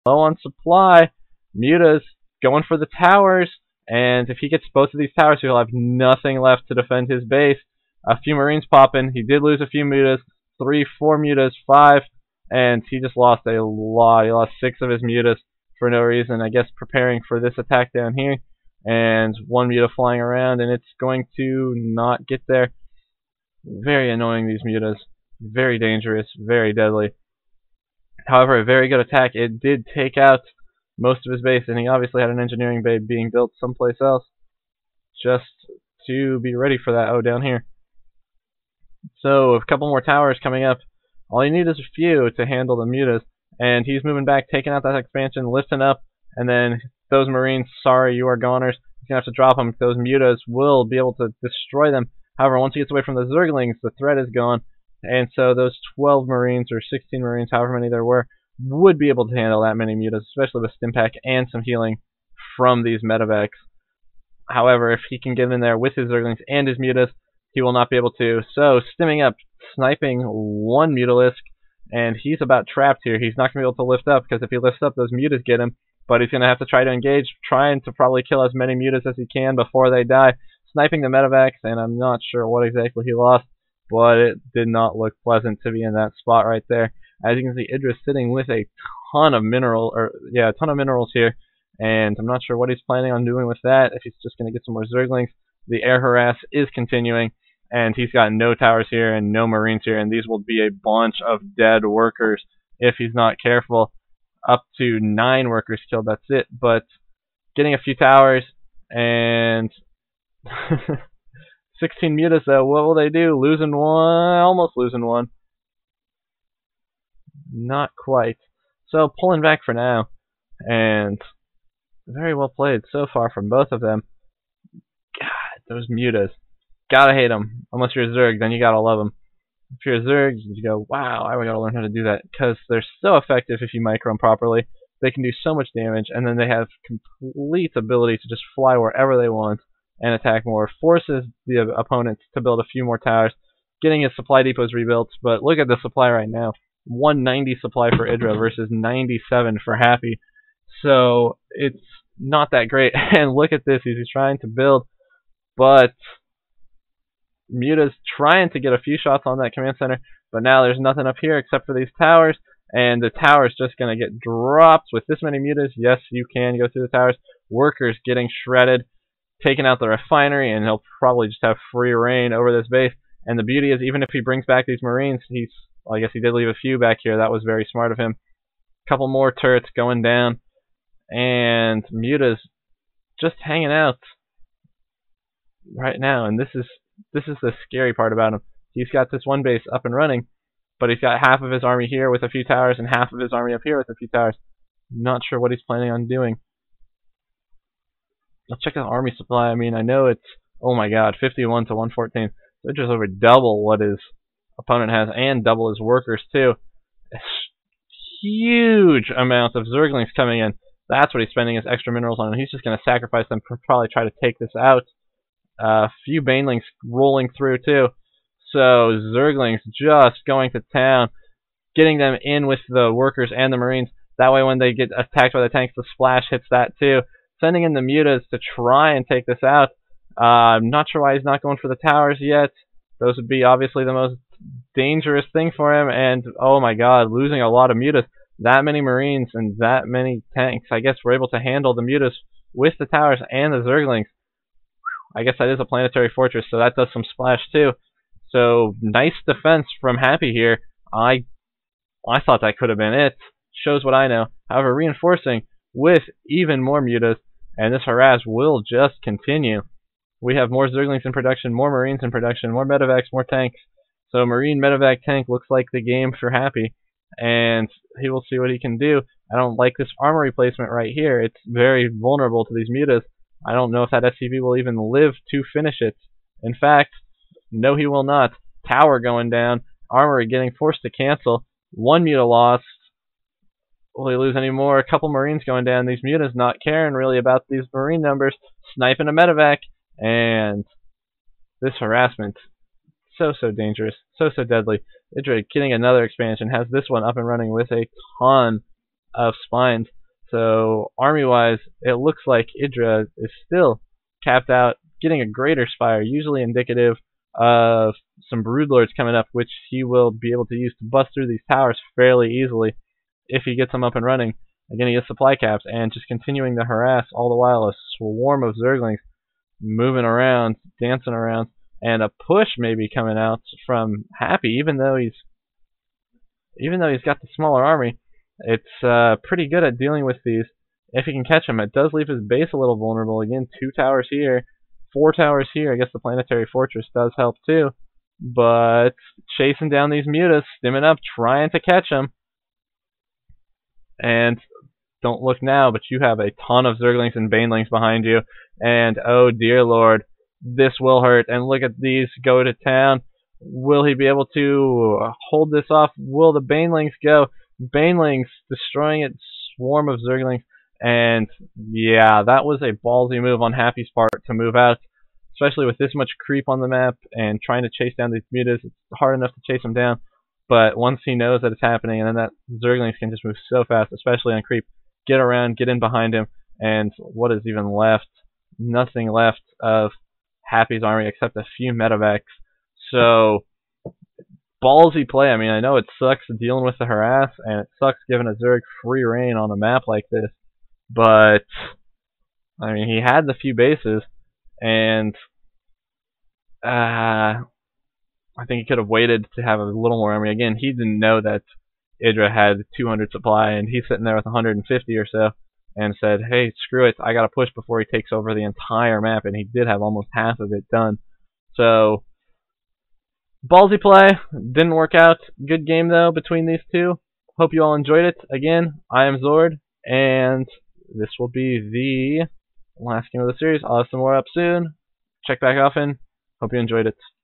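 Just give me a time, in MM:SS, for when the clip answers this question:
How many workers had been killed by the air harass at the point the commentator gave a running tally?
01:44.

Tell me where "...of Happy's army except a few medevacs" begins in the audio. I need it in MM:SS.
06:19.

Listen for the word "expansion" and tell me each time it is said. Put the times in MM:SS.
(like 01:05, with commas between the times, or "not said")
00:44, 04:56.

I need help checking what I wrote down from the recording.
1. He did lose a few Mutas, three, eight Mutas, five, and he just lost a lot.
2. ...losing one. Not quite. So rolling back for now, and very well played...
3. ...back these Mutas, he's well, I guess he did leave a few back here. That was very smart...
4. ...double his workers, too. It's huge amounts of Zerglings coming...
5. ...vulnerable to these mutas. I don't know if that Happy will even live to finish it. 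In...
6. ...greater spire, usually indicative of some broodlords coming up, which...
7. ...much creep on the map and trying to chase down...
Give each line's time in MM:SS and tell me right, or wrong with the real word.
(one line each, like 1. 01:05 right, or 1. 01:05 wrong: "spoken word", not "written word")
1. 00:09 wrong: "four", not "eight"
2. 01:54 wrong: "pulling", not "rolling"
3. 02:54 wrong: "Marines", not "Mutas"
4. 03:25 right
5. 04:31 wrong: "SCV", not "Happy"
6. 05:05 right
7. 06:05 right.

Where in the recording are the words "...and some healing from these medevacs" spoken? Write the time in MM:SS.
01:01.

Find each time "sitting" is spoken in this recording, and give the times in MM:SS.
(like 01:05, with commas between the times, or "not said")
01:28, 06:43.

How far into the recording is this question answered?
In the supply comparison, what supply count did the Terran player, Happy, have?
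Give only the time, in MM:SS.
02:28.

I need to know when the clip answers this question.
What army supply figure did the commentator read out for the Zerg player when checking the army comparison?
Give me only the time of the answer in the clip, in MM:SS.
03:21.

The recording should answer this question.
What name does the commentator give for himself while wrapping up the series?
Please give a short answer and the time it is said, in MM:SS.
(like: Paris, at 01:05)
Zord, at 06:59.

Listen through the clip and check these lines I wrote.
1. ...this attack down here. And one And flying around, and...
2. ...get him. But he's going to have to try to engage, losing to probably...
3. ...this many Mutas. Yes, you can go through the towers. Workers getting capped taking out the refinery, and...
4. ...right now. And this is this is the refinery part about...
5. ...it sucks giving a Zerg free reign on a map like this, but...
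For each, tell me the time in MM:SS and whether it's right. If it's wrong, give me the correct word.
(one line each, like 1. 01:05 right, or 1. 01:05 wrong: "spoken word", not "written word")
1. 00:17 wrong: "Muta", not "And"
2. 01:15 wrong: "trying", not "losing"
3. 02:45 wrong: "shredded", not "capped"
4. 03:05 wrong: "scary", not "refinery"
5. 06:27 right.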